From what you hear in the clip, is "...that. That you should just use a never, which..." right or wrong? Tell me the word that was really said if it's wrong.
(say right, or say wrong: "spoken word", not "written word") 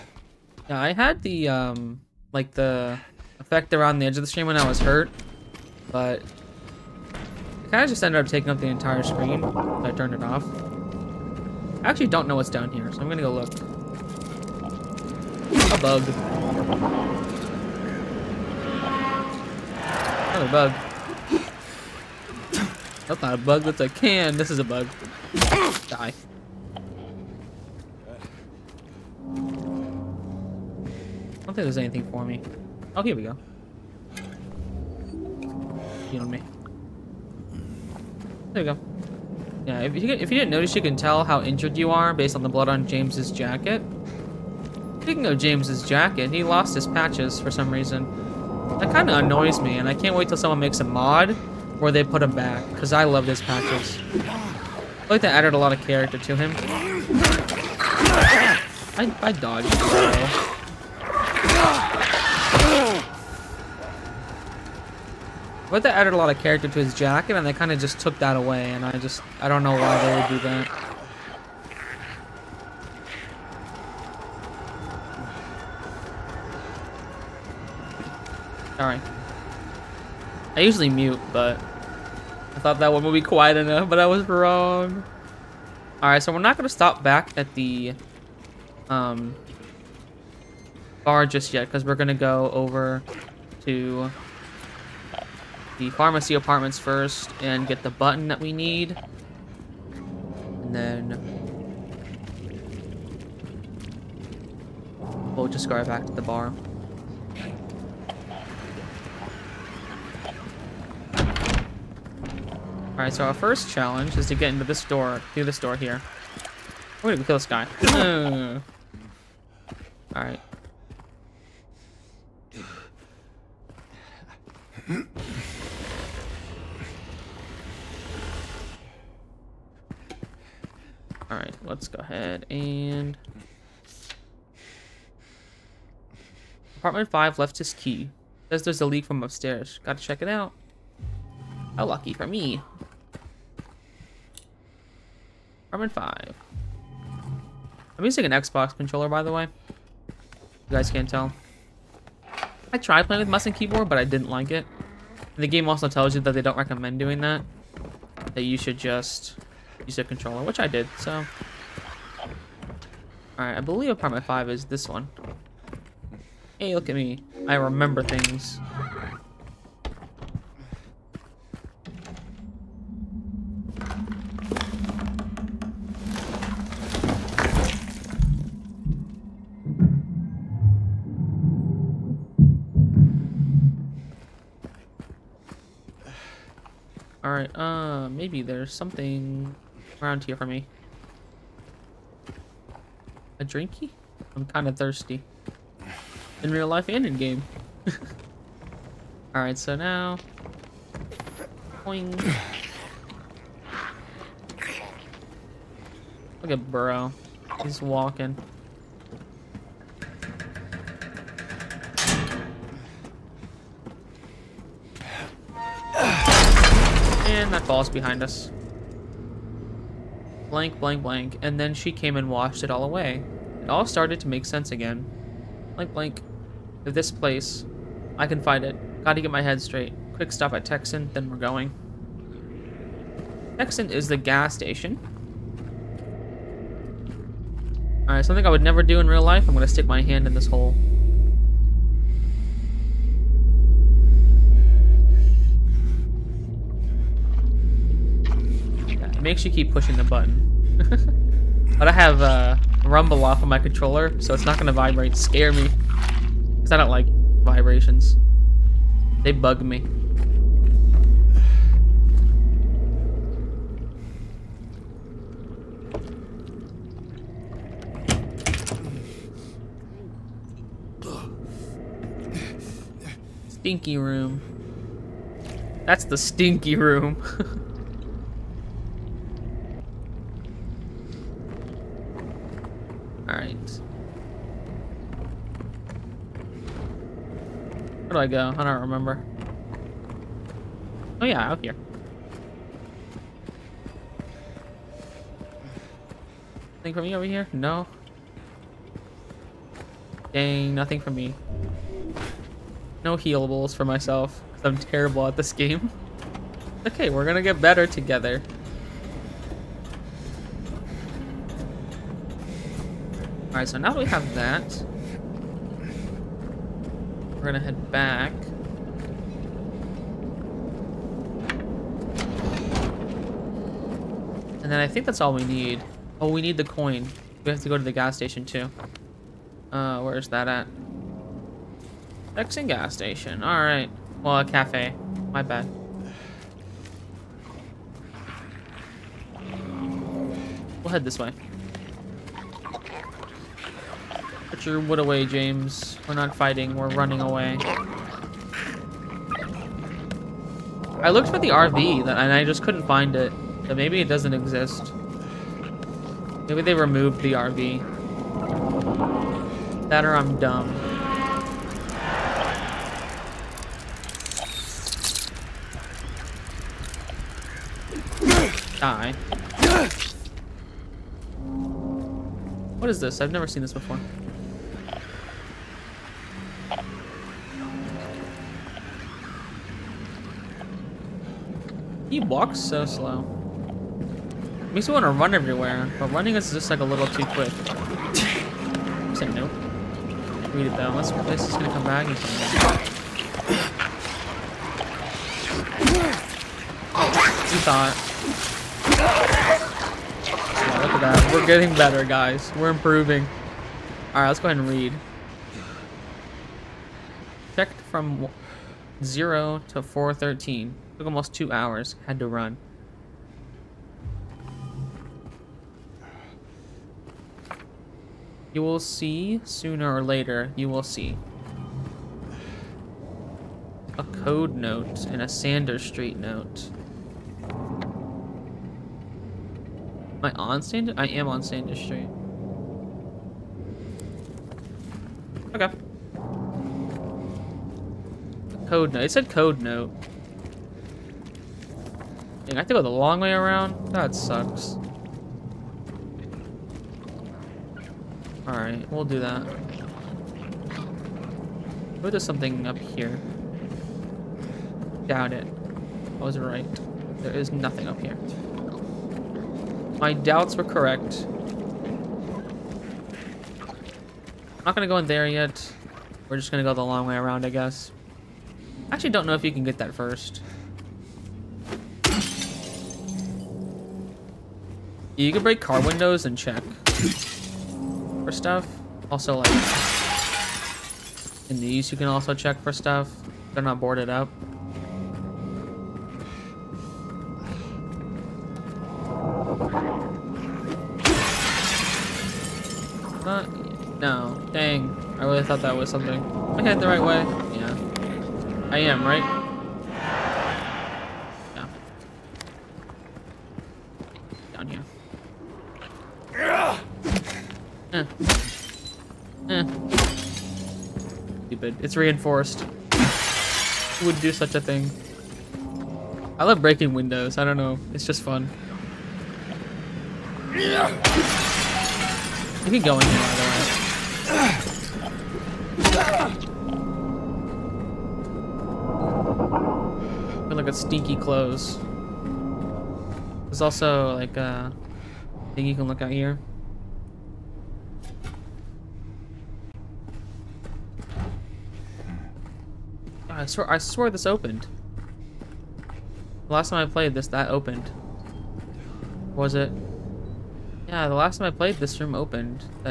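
wrong: "controller", not "never".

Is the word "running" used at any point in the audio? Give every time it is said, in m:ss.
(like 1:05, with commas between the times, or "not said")
5:46, 6:26.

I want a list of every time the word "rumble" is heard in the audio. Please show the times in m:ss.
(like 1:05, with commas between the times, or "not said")
4:12.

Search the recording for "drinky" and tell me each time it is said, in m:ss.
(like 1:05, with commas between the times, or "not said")
3:13.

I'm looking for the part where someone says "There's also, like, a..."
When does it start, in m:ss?
8:53.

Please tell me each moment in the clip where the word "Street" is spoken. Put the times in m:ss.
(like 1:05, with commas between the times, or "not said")
7:05, 7:11.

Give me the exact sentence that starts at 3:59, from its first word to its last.
I'm gonna stick my hand in this hole.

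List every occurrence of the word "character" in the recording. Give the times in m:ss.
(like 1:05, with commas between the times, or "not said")
0:55, 1:06.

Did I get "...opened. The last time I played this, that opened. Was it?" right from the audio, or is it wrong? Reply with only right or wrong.
right.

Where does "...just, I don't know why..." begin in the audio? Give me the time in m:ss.
1:08.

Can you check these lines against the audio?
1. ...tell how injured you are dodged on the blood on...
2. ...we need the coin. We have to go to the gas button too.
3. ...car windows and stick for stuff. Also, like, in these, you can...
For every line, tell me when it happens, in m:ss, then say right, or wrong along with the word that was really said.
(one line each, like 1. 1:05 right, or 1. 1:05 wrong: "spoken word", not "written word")
1. 0:40 wrong: "based", not "dodged"
2. 5:26 wrong: "station", not "button"
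3. 7:55 wrong: "check", not "stick".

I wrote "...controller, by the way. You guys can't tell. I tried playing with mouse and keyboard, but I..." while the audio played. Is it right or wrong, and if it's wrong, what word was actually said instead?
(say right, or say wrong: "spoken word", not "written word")
right.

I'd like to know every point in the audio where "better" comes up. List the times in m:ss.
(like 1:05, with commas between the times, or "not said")
5:07, 6:41.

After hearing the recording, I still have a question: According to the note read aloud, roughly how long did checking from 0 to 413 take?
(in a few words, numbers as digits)
Almost two hours.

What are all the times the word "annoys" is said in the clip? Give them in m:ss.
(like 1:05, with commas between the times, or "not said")
0:49.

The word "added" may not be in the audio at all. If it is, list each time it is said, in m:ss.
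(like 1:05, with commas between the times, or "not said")
0:55, 1:05.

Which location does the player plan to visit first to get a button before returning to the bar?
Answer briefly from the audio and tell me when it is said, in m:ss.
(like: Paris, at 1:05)
Pharmacy apartments, at 1:35.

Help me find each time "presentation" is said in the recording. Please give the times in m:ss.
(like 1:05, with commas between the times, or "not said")
not said.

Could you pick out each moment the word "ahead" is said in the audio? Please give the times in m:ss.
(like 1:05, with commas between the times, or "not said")
2:11, 6:44.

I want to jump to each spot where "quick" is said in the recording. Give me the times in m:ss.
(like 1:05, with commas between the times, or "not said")
3:50, 6:27.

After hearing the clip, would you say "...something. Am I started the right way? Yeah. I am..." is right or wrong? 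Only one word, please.
wrong.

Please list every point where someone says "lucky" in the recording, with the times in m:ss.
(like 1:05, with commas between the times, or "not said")
2:21.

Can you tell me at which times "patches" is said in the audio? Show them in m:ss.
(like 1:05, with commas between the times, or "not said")
0:46, 0:53.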